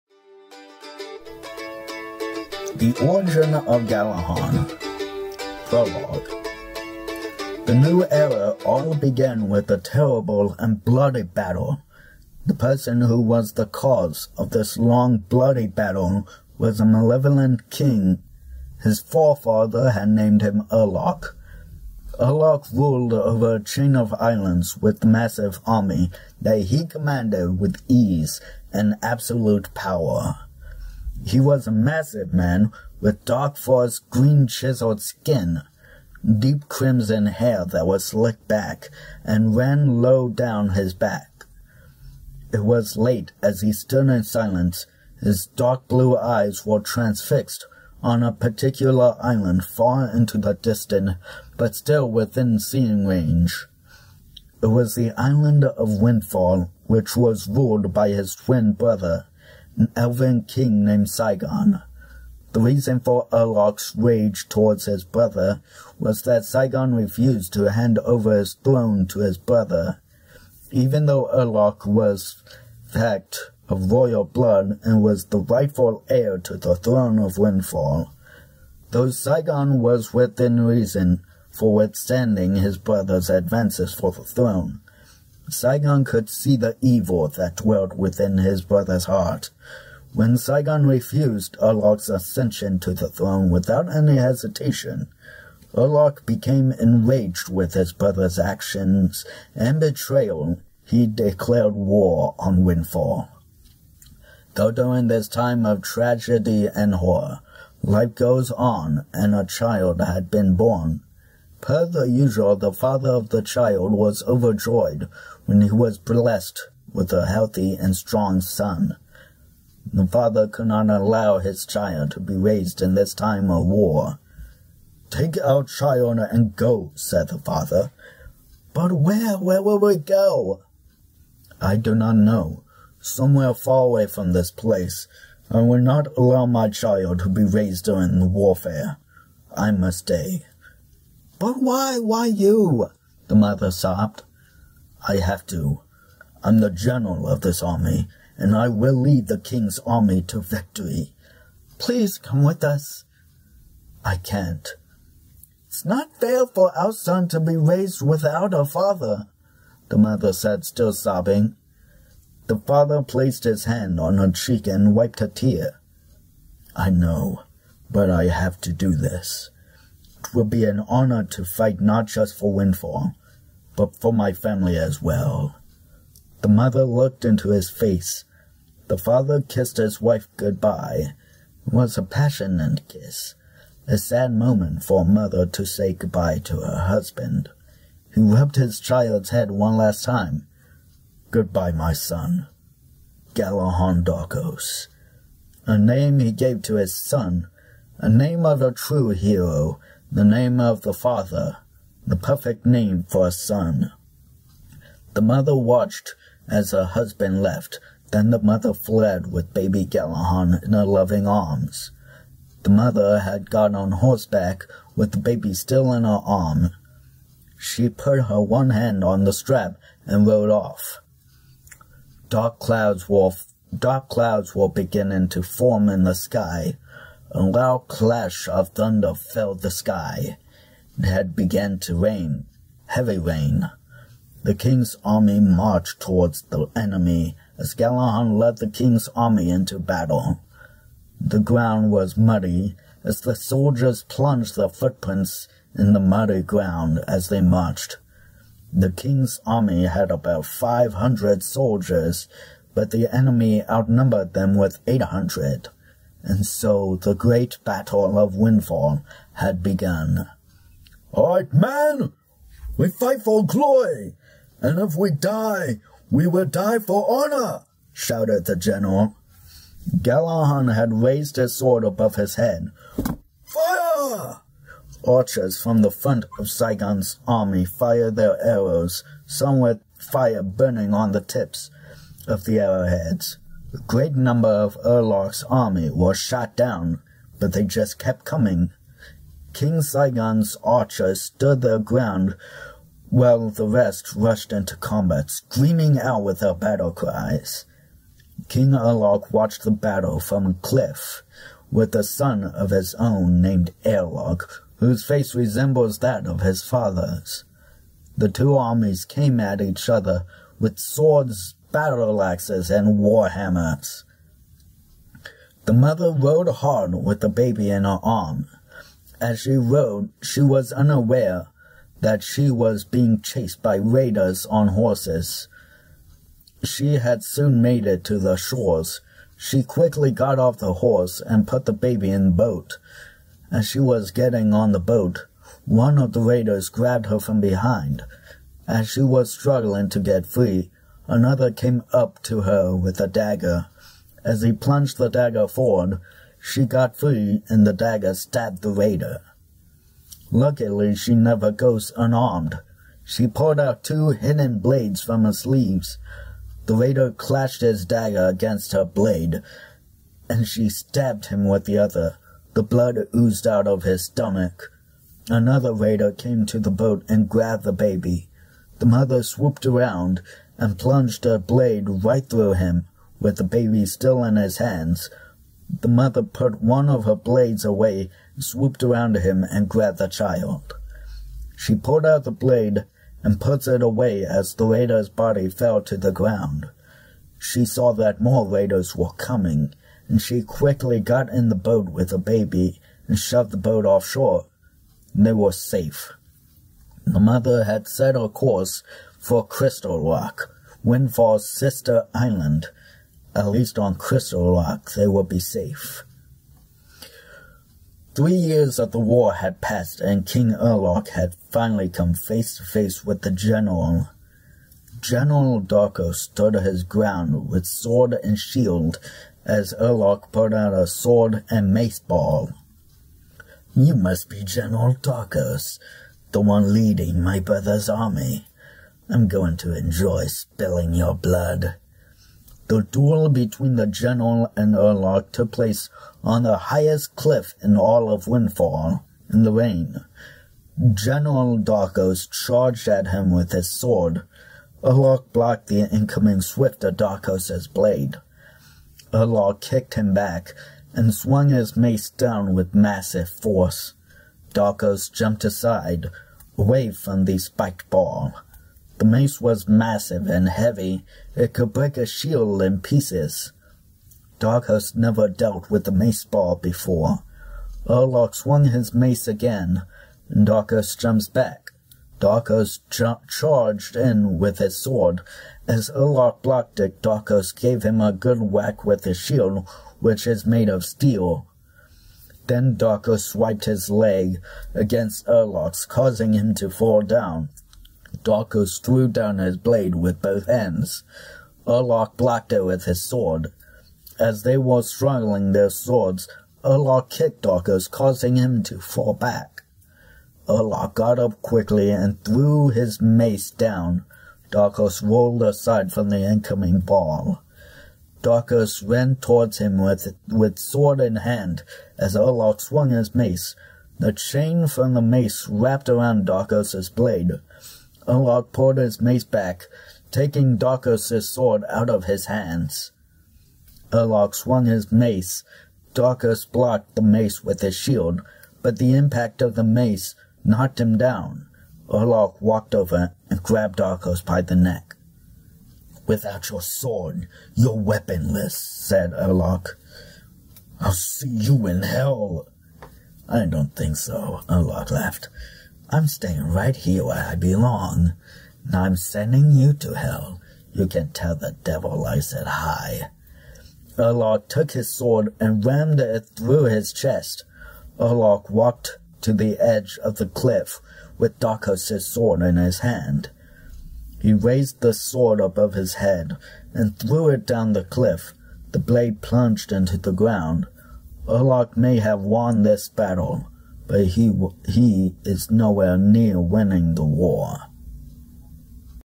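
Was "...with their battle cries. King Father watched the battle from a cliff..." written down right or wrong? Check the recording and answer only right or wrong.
wrong.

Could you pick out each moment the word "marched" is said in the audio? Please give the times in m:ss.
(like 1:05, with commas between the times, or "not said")
3:55, 4:07.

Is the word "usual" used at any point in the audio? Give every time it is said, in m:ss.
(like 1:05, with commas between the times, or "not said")
1:52.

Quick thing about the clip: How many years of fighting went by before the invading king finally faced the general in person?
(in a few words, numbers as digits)
3.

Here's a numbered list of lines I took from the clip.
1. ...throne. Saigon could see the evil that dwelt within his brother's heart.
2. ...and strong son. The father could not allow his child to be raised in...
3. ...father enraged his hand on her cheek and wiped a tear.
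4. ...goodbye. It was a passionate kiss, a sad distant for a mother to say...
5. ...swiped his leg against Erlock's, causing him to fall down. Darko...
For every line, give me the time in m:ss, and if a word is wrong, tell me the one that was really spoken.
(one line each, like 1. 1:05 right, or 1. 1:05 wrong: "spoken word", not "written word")
1. 1:24 right
2. 1:57 right
3. 2:42 wrong: "placed", not "enraged"
4. 3:00 wrong: "moment", not "distant"
5. 8:03 right.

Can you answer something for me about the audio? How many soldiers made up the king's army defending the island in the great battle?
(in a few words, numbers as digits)
500.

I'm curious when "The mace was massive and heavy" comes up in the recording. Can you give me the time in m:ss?
7:39.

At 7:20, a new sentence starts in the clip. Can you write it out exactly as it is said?
General Darkos charged at him with his sword.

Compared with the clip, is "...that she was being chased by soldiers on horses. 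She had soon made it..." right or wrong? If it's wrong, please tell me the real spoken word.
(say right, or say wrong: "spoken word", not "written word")
wrong: "raiders", not "soldiers".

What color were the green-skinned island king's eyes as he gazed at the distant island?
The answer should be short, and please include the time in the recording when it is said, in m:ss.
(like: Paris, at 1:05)
Dark blue, at 0:45.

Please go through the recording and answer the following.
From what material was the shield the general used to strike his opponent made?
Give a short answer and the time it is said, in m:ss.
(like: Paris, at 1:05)
Steel, at 7:59.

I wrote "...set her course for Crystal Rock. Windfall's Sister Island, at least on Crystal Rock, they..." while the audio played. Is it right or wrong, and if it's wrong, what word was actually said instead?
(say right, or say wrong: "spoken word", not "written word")
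right.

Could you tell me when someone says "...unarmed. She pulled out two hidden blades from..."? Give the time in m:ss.
5:51.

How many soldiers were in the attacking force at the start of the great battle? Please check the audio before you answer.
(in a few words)
800.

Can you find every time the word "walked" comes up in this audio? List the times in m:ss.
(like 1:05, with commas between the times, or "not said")
8:52, 9:18.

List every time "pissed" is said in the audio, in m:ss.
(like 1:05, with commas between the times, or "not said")
not said.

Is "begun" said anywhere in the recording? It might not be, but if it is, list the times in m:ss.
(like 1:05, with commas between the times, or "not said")
3:51, 4:19.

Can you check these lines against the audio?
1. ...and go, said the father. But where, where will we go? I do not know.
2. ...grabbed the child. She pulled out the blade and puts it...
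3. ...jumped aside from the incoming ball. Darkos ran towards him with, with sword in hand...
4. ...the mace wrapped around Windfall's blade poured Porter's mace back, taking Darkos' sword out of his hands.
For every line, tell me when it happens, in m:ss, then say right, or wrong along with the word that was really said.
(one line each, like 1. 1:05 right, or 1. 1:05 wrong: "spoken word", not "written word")
1. 2:06 right
2. 6:19 right
3. 8:25 wrong: "rolled", not "jumped"
4. 8:34 wrong: "Darkos", not "Windfall".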